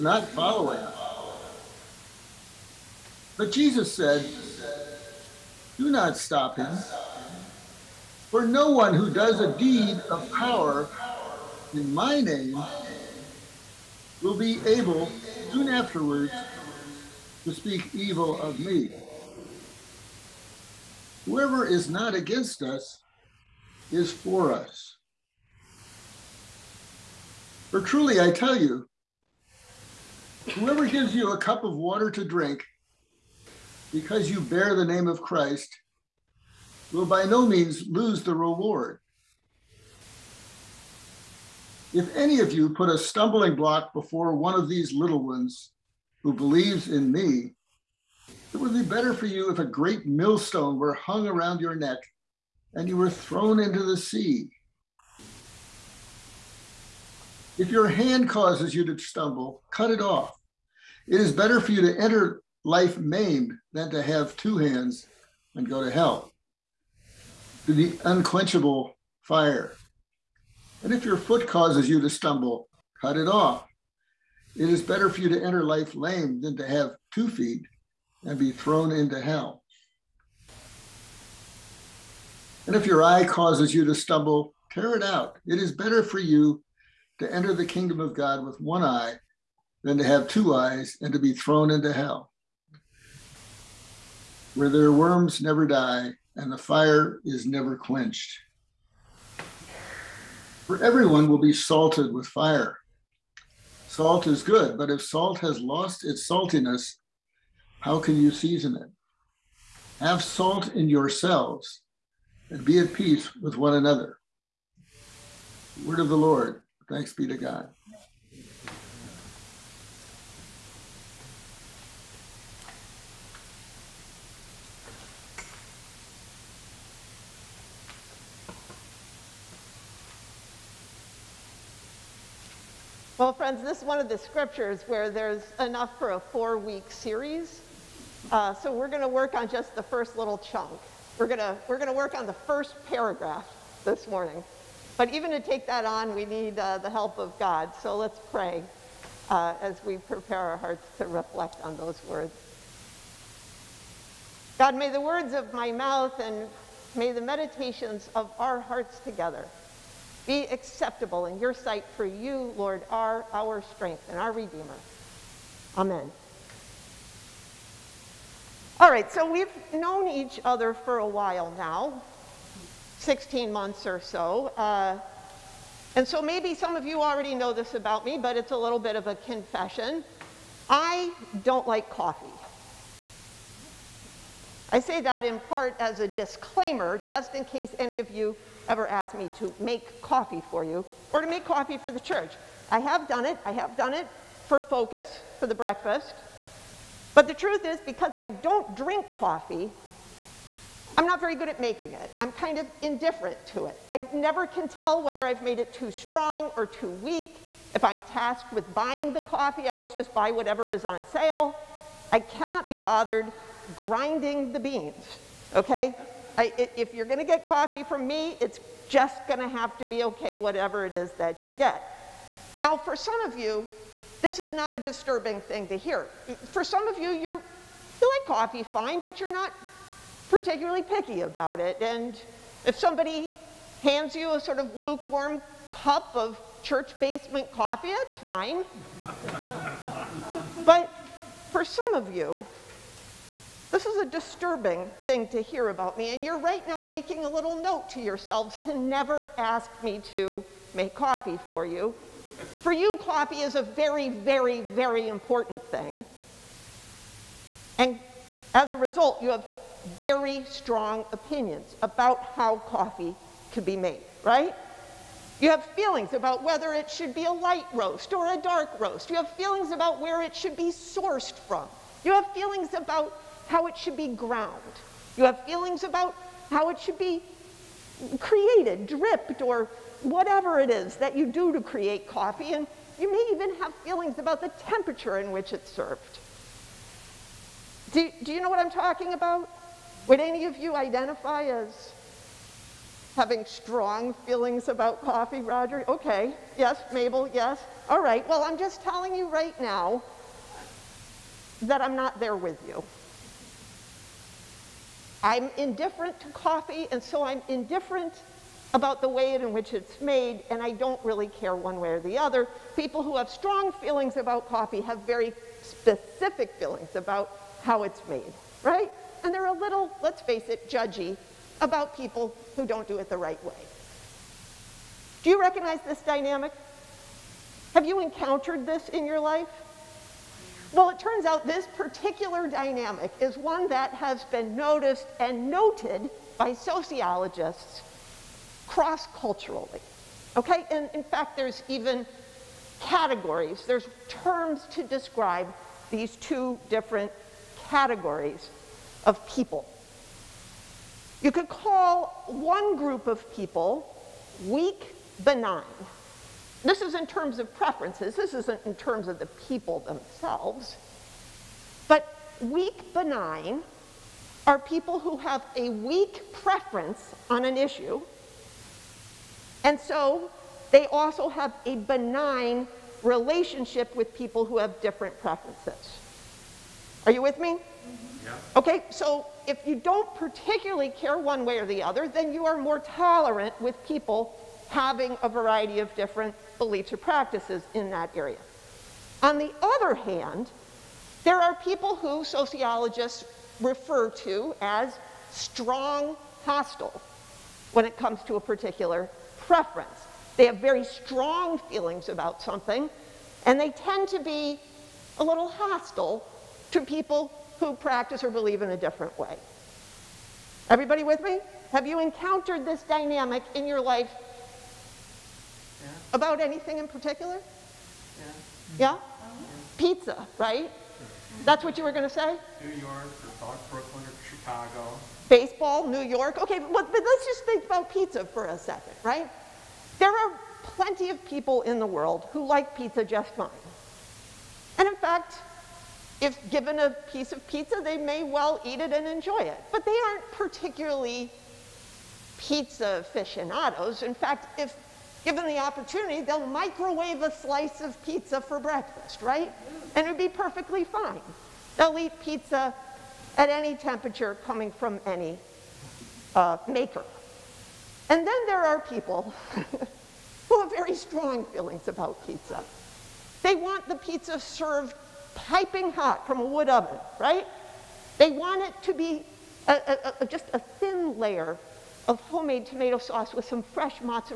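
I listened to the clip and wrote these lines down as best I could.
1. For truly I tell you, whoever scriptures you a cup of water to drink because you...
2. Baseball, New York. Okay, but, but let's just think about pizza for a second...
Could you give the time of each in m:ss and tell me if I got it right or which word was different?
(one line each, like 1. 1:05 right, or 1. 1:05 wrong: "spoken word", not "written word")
1. 0:27 wrong: "gives", not "scriptures"
2. 7:05 right.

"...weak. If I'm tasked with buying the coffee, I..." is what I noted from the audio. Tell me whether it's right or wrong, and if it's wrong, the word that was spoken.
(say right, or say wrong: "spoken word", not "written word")
right.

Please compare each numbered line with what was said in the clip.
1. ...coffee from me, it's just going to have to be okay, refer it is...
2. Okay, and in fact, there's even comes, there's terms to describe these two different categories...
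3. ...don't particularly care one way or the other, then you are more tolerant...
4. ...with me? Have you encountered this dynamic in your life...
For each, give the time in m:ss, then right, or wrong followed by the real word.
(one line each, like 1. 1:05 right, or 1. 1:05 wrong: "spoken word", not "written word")
1. 3:37 wrong: "whatever", not "refer"
2. 5:40 wrong: "categories", not "comes"
3. 6:19 right
4. 6:51 right.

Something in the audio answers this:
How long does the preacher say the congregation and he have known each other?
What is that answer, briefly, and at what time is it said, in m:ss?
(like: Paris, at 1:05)
16 months, at 2:52.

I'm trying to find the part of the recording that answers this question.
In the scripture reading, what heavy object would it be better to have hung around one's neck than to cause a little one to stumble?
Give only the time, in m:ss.
0:49.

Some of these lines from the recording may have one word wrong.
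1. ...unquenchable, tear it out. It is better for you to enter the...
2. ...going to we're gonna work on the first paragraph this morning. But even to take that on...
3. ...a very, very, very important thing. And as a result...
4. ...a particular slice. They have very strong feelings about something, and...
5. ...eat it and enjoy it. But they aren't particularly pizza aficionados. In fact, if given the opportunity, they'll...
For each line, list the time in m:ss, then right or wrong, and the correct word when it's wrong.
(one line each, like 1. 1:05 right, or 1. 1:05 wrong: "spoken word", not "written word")
1. 1:23 wrong: "stumble", not "unquenchable"
2. 2:21 right
3. 4:13 right
4. 6:38 wrong: "preference", not "slice"
5. 7:18 right.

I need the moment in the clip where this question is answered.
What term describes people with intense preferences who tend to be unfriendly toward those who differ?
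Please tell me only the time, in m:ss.
6:35.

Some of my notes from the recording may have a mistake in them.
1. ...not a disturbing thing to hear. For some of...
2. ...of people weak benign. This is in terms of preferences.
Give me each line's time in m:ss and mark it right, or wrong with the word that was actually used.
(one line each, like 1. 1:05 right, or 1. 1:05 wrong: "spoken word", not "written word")
1. 3:44 right
2. 5:53 right.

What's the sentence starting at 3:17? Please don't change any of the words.
But the truth is, because I don't drink coffee, I'm not very good at making it.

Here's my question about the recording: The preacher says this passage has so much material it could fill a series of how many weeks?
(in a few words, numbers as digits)
4.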